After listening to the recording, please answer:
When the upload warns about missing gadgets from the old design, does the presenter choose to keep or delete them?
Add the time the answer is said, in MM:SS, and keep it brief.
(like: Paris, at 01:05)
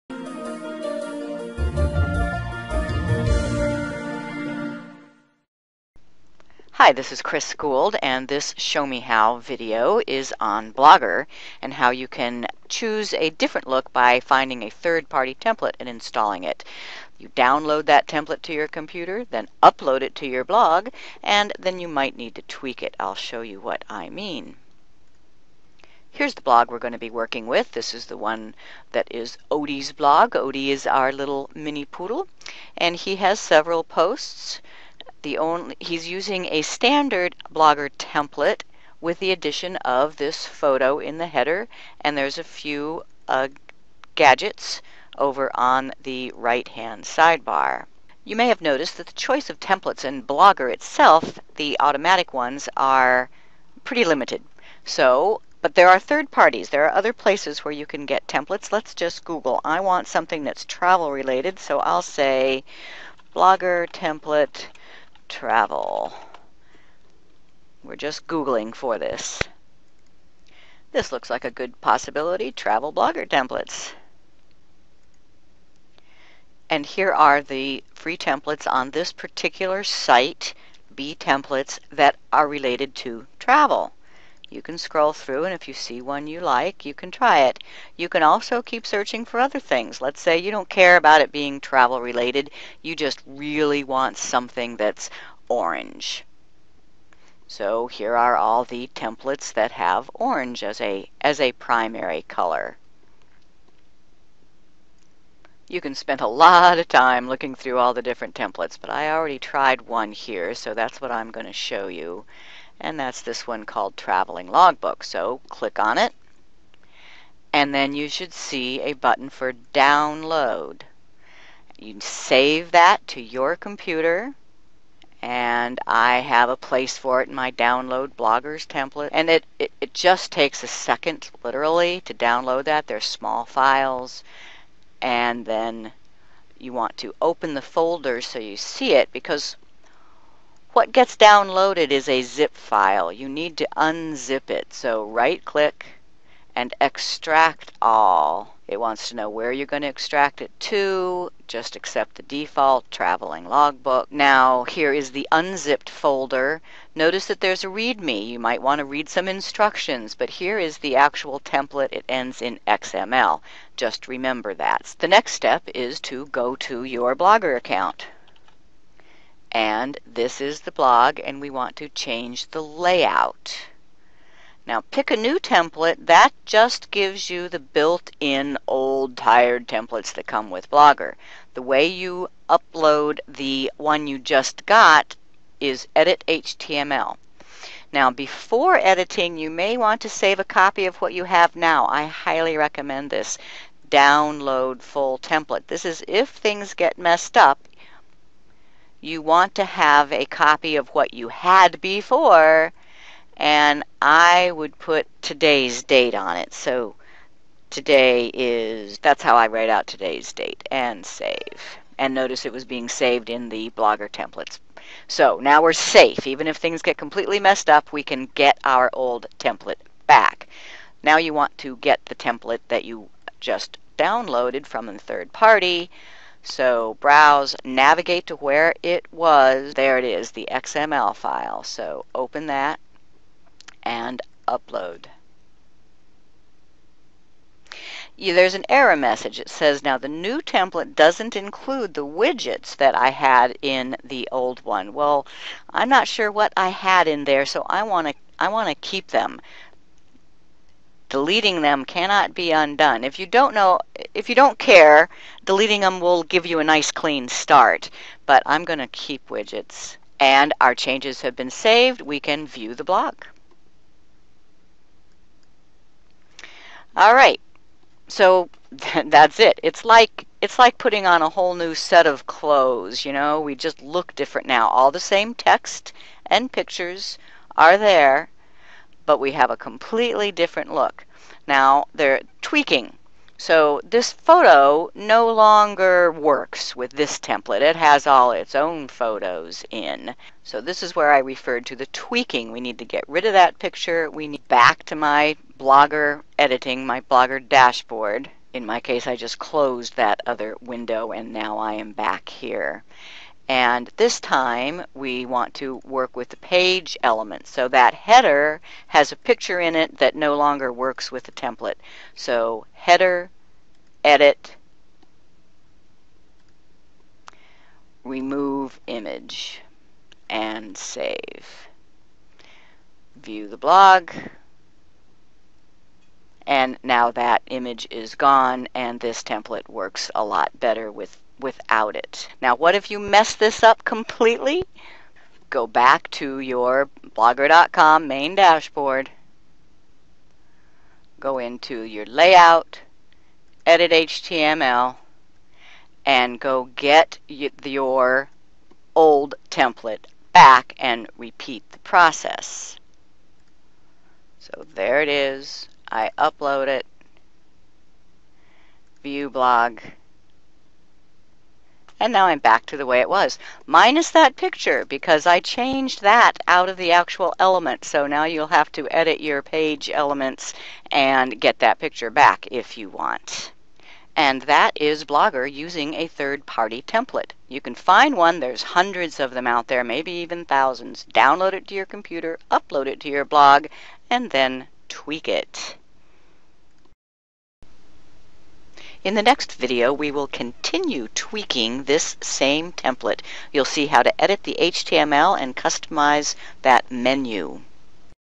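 Keep widgets, at 04:18.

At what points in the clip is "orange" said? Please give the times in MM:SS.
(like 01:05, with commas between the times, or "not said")
01:35, 01:40.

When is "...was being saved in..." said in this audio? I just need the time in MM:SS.
03:32.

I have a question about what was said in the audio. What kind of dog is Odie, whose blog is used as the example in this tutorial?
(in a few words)
Mini poodle.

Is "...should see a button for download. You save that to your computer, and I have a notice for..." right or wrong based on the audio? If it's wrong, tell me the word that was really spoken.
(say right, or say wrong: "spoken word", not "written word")
wrong: "place", not "notice".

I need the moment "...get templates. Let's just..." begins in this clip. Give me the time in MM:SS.
00:58.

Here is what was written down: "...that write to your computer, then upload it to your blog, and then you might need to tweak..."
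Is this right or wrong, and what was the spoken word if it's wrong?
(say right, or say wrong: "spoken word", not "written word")
wrong: "template", not "write".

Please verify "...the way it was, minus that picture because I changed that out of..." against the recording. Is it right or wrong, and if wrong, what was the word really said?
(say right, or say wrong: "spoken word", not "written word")
right.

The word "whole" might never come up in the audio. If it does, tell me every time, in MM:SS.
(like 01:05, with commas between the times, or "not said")
04:31.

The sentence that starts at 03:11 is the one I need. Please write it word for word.
I highly recommend this download full template.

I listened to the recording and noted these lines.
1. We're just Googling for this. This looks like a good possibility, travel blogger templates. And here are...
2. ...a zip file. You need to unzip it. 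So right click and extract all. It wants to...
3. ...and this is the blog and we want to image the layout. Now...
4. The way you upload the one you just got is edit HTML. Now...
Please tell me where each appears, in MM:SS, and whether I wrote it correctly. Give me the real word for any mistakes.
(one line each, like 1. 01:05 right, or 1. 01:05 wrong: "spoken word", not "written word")
1. 01:07 right
2. 02:22 right
3. 02:49 wrong: "change", not "image"
4. 03:01 right.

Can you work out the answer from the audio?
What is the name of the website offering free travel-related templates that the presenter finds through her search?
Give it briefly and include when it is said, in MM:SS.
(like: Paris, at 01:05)
B templates, at 01:20.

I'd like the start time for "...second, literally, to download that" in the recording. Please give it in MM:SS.
02:10.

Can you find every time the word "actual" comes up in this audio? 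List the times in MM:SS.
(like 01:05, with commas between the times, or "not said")
02:40, 06:06.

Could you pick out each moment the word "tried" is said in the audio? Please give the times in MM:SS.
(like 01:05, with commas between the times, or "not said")
01:49.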